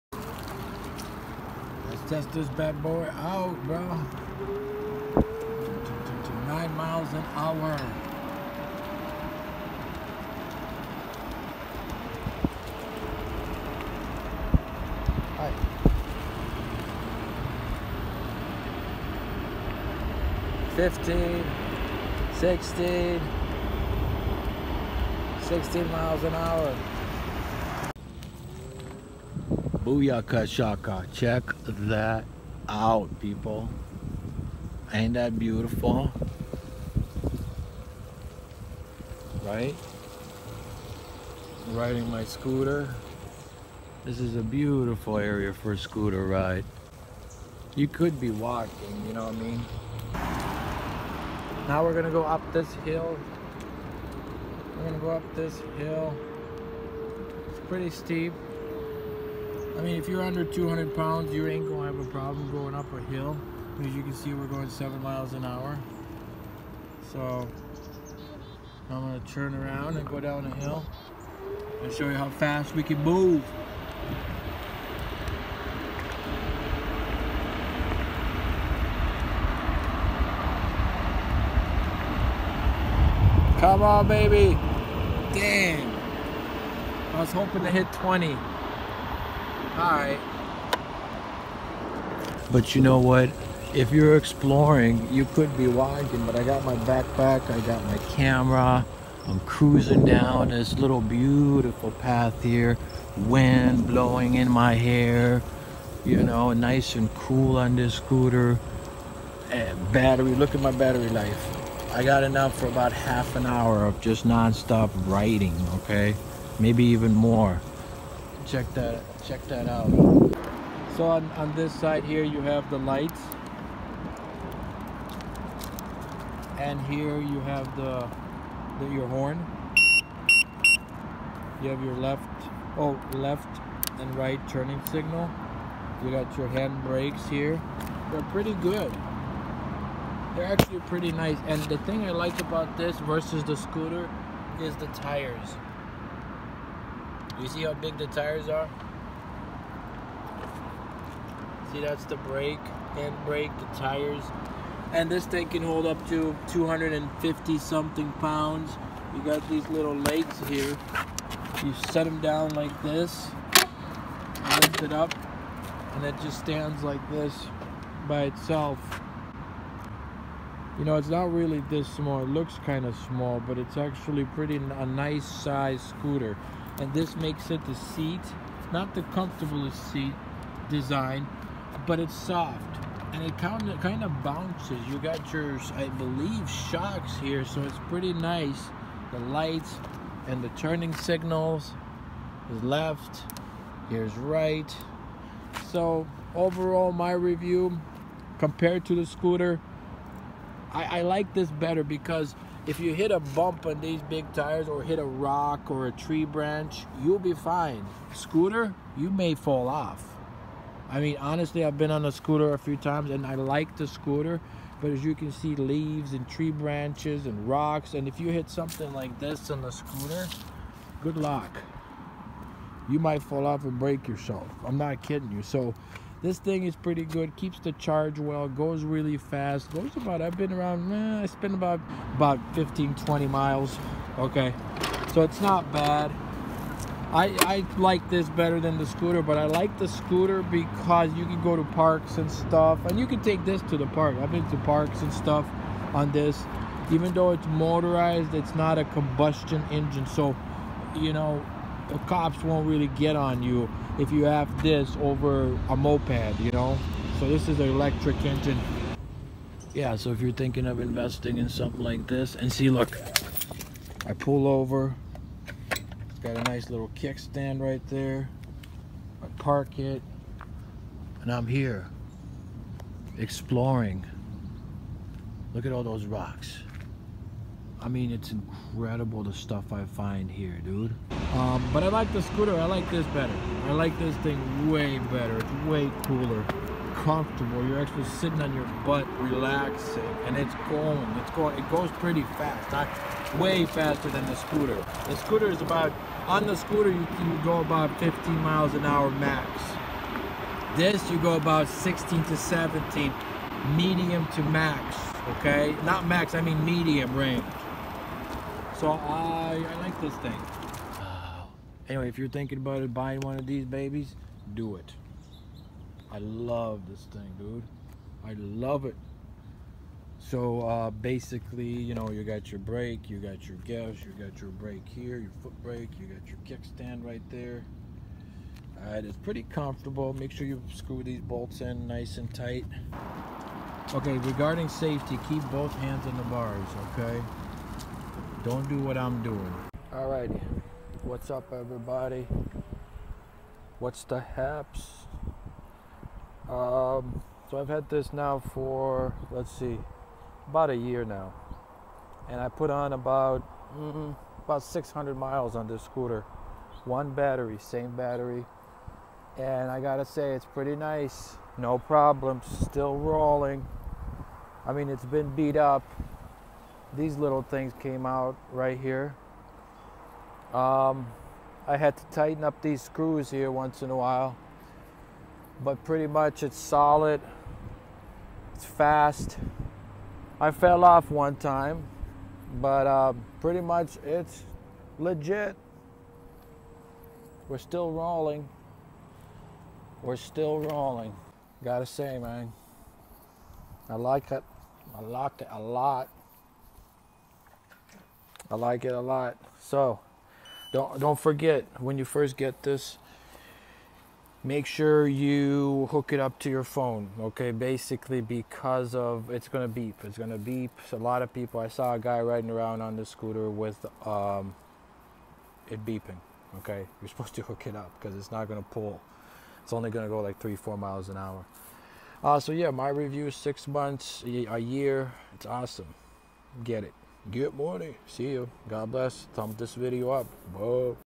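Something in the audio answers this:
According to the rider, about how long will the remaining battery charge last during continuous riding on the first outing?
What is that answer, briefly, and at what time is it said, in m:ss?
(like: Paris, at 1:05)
half an hour, at 1:52.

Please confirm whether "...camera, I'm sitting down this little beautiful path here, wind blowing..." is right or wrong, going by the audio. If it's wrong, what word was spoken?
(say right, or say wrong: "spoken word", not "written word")
wrong: "cruising", not "sitting".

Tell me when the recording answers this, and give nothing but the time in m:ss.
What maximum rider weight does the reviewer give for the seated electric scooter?
2:36.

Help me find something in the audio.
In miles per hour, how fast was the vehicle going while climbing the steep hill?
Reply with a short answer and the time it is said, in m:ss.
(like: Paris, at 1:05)
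7 miles an hour, at 1:04.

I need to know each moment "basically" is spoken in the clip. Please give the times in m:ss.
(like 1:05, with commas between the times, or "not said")
5:20, 6:47.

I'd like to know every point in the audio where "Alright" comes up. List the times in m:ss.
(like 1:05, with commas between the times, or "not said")
1:29, 5:28.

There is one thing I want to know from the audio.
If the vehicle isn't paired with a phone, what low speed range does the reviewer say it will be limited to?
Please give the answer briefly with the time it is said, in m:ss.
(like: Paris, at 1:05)
3 to 4 miles an hour, at 7:00.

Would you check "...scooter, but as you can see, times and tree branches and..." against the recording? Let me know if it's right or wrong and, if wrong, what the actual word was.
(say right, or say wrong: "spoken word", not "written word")
wrong: "leaves", not "times".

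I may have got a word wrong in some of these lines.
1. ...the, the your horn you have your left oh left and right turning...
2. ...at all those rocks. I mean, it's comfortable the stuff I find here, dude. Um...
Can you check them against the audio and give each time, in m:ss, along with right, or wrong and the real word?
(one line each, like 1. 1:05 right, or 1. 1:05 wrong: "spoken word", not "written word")
1. 2:07 right
2. 4:35 wrong: "incredible", not "comfortable".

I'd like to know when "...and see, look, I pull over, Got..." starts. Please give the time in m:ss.
4:22.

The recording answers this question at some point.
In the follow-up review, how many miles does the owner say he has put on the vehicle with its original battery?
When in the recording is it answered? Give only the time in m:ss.
5:54.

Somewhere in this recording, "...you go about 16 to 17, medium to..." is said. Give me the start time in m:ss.
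5:01.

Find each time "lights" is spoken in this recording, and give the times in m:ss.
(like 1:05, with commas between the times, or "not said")
2:02, 3:09.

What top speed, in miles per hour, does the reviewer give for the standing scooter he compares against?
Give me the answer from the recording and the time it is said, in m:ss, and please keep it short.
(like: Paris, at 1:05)
15 miles an hour, at 4:57.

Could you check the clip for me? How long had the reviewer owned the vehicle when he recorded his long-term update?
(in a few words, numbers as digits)
about a year.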